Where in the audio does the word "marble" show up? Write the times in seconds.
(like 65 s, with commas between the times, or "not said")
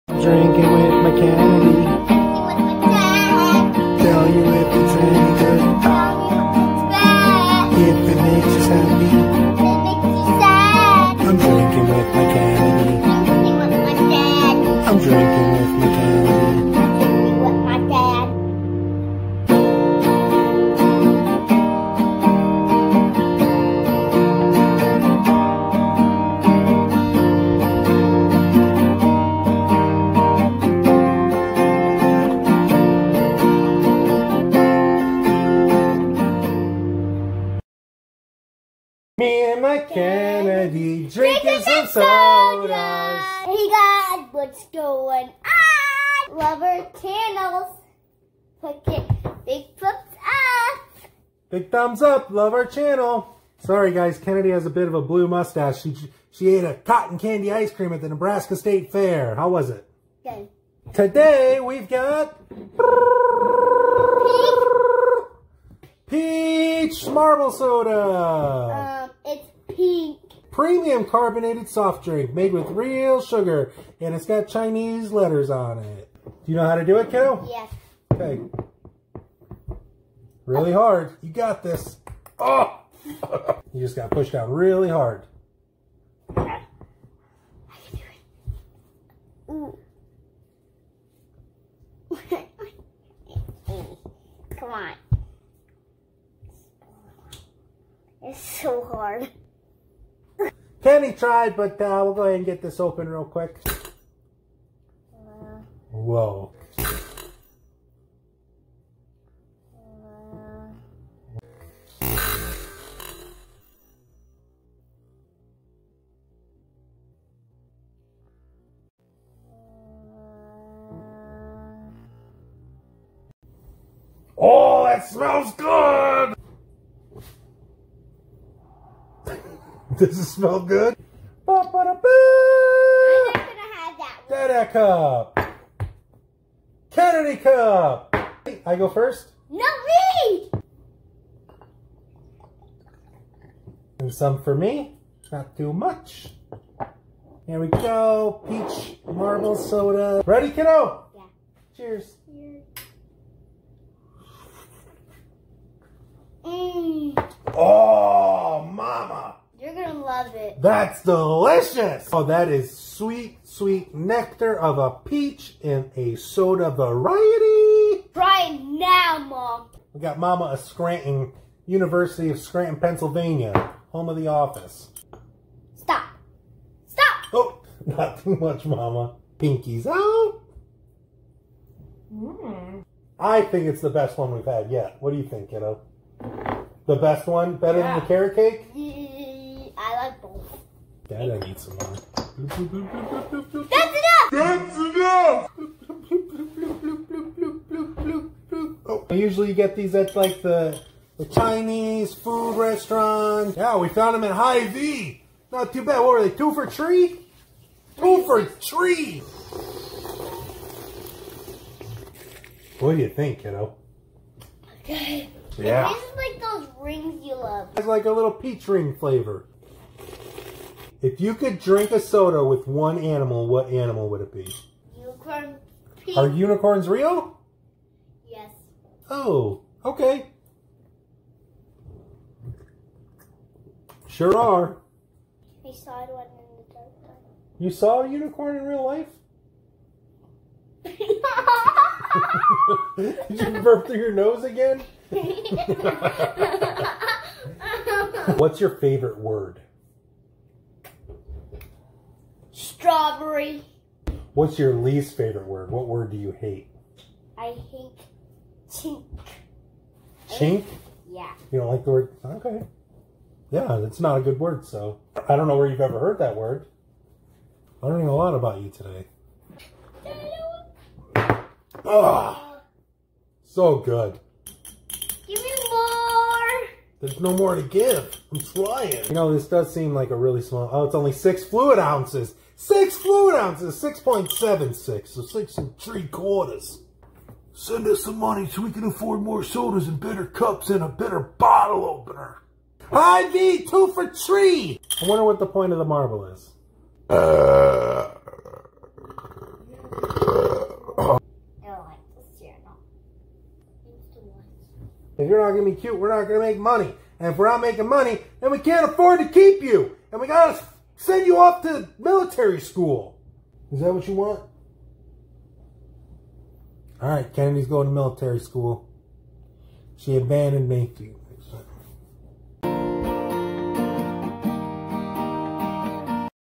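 67 s, 149 s, 295 s.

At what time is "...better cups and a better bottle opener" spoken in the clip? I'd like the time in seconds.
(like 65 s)
289 s.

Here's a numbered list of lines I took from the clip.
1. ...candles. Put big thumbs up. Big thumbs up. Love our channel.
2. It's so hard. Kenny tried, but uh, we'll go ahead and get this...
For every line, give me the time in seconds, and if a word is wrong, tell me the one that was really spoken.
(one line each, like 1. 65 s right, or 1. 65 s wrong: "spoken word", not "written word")
1. 47 s right
2. 98 s right.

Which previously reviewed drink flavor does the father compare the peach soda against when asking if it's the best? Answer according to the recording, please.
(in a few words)
carrot cake.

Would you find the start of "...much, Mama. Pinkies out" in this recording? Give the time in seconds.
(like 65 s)
178 s.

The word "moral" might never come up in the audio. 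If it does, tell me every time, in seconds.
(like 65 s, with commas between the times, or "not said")
not said.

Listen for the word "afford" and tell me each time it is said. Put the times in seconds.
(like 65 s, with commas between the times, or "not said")
288 s, 308 s.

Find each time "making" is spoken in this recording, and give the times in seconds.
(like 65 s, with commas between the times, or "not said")
307 s.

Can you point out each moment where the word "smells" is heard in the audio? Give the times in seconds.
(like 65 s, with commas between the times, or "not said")
125 s, 130 s.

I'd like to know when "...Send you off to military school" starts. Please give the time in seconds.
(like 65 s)
311 s.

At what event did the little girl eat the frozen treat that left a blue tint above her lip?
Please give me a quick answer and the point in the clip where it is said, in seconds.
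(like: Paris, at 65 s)
Nebraska State Fair, at 58 s.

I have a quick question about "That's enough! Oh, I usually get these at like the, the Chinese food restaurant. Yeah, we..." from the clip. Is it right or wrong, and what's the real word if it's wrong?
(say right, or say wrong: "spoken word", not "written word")
right.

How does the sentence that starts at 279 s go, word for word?
You know, this does seem like a really small...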